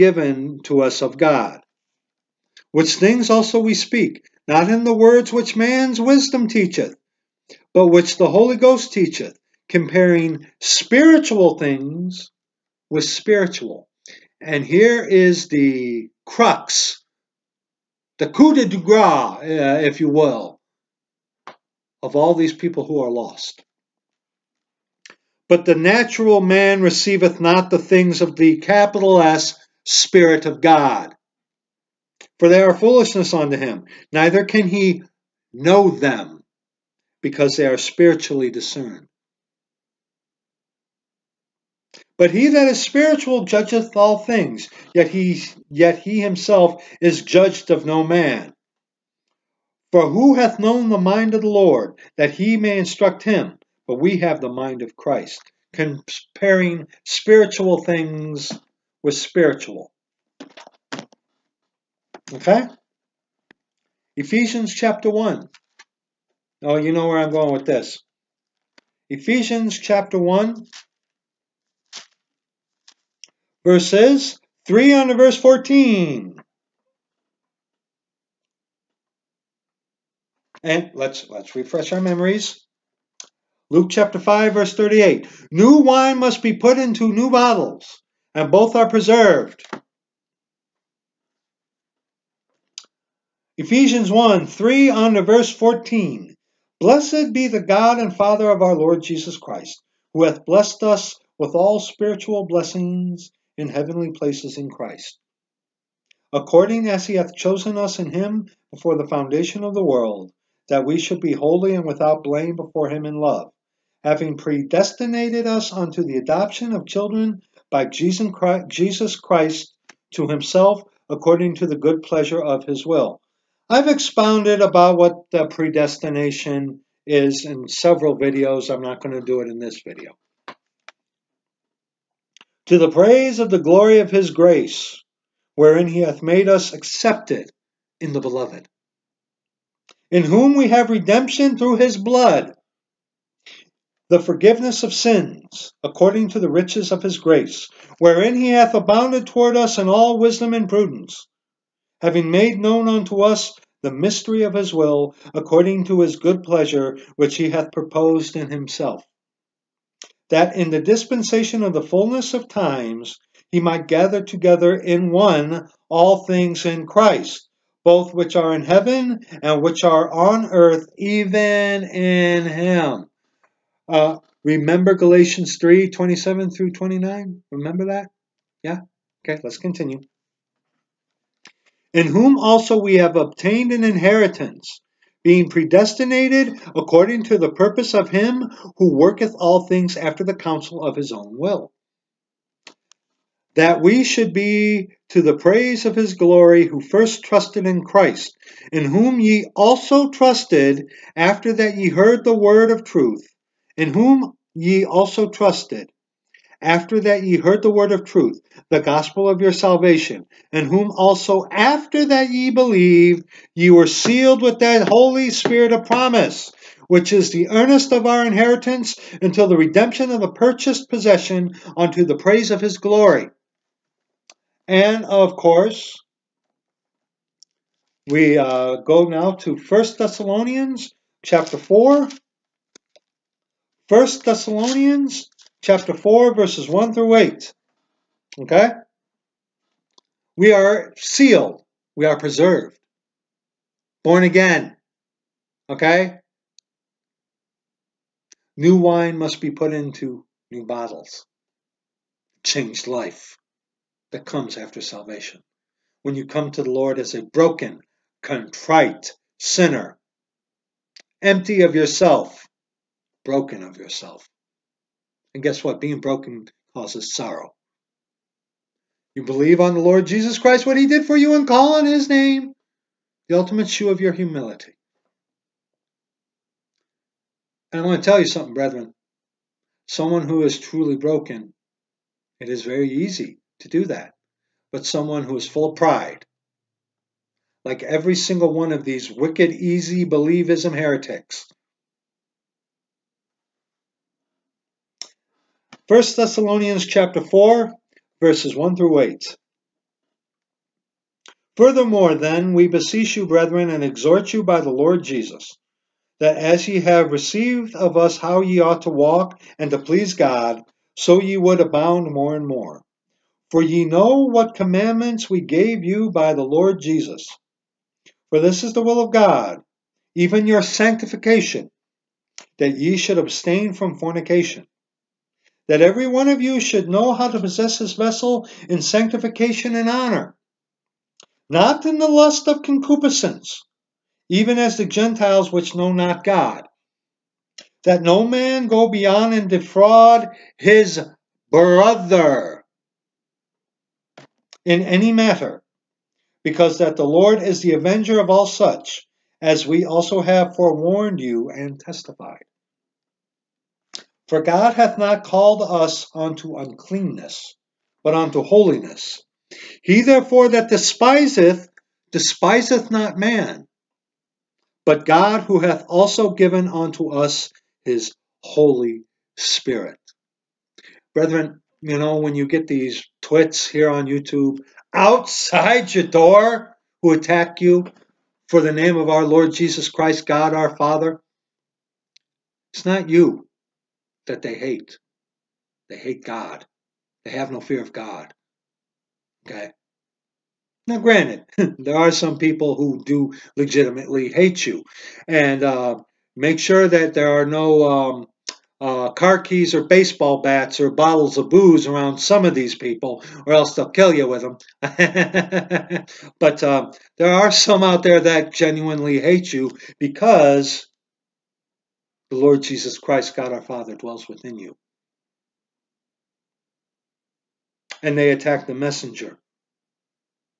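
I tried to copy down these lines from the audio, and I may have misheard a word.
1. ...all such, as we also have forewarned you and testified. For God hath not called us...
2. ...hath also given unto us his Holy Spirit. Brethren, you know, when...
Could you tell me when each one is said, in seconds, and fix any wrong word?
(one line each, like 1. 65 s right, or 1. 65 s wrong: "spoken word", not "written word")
1. 348 s right
2. 365 s right.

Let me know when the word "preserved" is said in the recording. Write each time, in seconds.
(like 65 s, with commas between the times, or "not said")
88 s, 242 s.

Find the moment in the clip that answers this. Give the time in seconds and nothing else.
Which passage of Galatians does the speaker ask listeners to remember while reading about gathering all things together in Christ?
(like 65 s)
174 s.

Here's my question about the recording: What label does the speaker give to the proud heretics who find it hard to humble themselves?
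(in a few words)
easy believism.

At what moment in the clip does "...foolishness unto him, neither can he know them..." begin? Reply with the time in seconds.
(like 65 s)
32 s.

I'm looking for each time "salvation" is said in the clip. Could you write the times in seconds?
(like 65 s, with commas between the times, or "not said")
209 s, 254 s.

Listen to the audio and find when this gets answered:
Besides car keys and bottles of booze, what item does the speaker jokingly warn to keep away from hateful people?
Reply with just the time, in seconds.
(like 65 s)
399 s.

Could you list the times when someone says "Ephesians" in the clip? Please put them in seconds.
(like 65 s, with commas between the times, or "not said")
64 s, 69 s, 93 s.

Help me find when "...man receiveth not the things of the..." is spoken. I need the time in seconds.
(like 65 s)
26 s.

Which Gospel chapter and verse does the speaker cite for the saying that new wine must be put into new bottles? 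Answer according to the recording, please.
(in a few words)
Luke 5:38.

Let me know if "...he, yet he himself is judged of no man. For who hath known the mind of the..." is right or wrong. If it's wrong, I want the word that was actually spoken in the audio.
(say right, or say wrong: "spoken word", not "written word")
right.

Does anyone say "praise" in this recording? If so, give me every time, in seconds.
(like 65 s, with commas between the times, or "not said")
132 s, 195 s, 222 s.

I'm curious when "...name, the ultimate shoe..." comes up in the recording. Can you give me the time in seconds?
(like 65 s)
272 s.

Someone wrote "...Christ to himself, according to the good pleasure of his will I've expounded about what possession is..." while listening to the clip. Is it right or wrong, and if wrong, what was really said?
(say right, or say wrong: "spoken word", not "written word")
wrong: "predestination", not "possession".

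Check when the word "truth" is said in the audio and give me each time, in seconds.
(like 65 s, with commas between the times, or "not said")
202 s, 208 s.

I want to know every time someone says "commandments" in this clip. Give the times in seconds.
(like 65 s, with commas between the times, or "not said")
314 s.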